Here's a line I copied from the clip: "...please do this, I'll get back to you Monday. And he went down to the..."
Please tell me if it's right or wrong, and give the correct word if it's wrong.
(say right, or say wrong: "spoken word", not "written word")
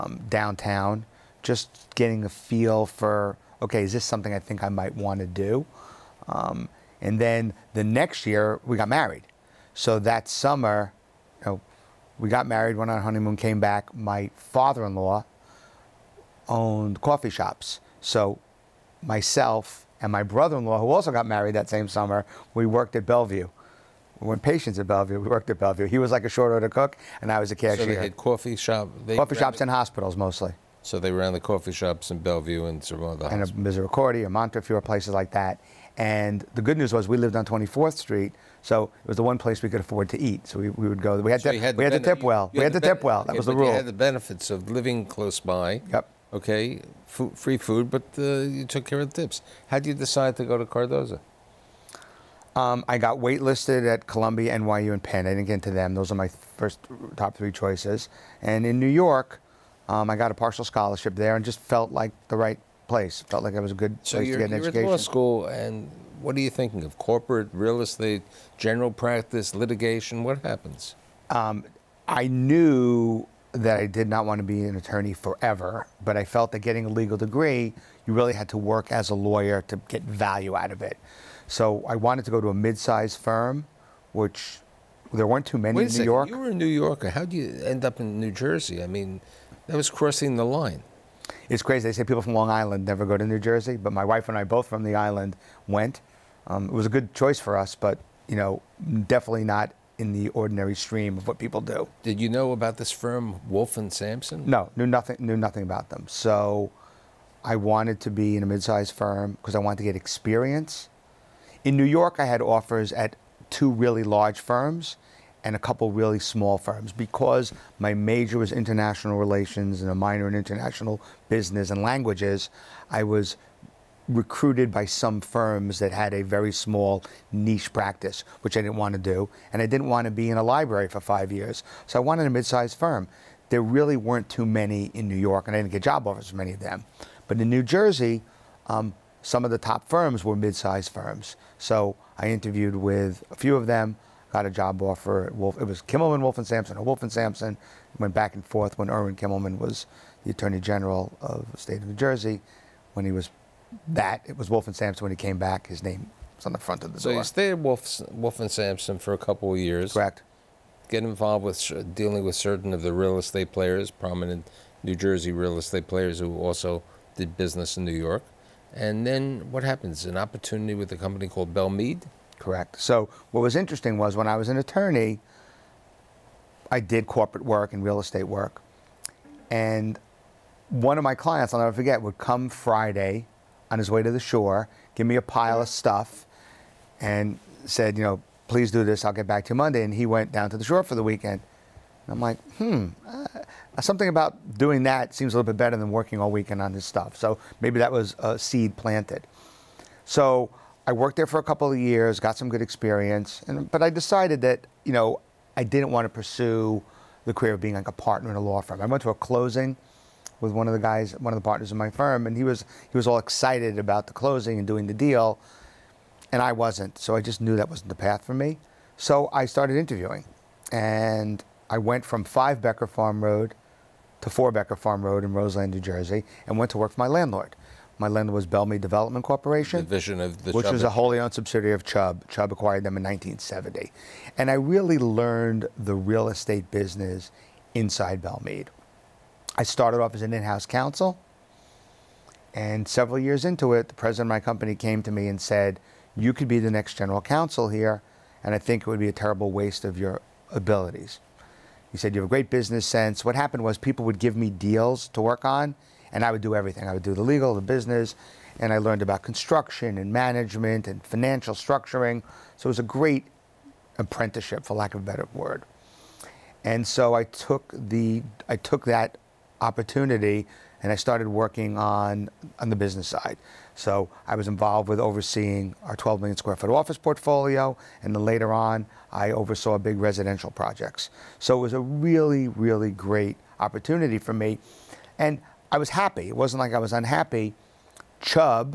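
right.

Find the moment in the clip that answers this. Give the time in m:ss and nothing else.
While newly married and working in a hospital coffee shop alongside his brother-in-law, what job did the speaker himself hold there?
0:27.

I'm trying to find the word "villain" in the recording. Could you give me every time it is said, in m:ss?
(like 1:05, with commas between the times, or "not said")
not said.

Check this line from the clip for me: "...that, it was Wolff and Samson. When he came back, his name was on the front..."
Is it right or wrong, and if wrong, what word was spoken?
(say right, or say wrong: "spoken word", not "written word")
right.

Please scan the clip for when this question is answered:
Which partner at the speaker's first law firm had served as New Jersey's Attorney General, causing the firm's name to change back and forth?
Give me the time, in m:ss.
2:28.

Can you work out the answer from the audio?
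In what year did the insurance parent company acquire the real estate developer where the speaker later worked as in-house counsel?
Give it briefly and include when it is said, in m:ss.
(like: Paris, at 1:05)
1970, at 3:53.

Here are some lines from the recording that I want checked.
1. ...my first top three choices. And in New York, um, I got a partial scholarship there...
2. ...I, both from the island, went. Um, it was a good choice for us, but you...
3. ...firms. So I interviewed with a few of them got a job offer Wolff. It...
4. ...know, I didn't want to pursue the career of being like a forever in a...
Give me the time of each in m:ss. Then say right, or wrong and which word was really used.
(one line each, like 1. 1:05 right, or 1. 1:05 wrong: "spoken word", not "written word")
1. 0:56 right
2. 1:34 right
3. 2:20 right
4. 3:24 wrong: "partner", not "forever".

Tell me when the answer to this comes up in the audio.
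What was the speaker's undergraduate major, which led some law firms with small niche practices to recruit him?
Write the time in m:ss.
1:58.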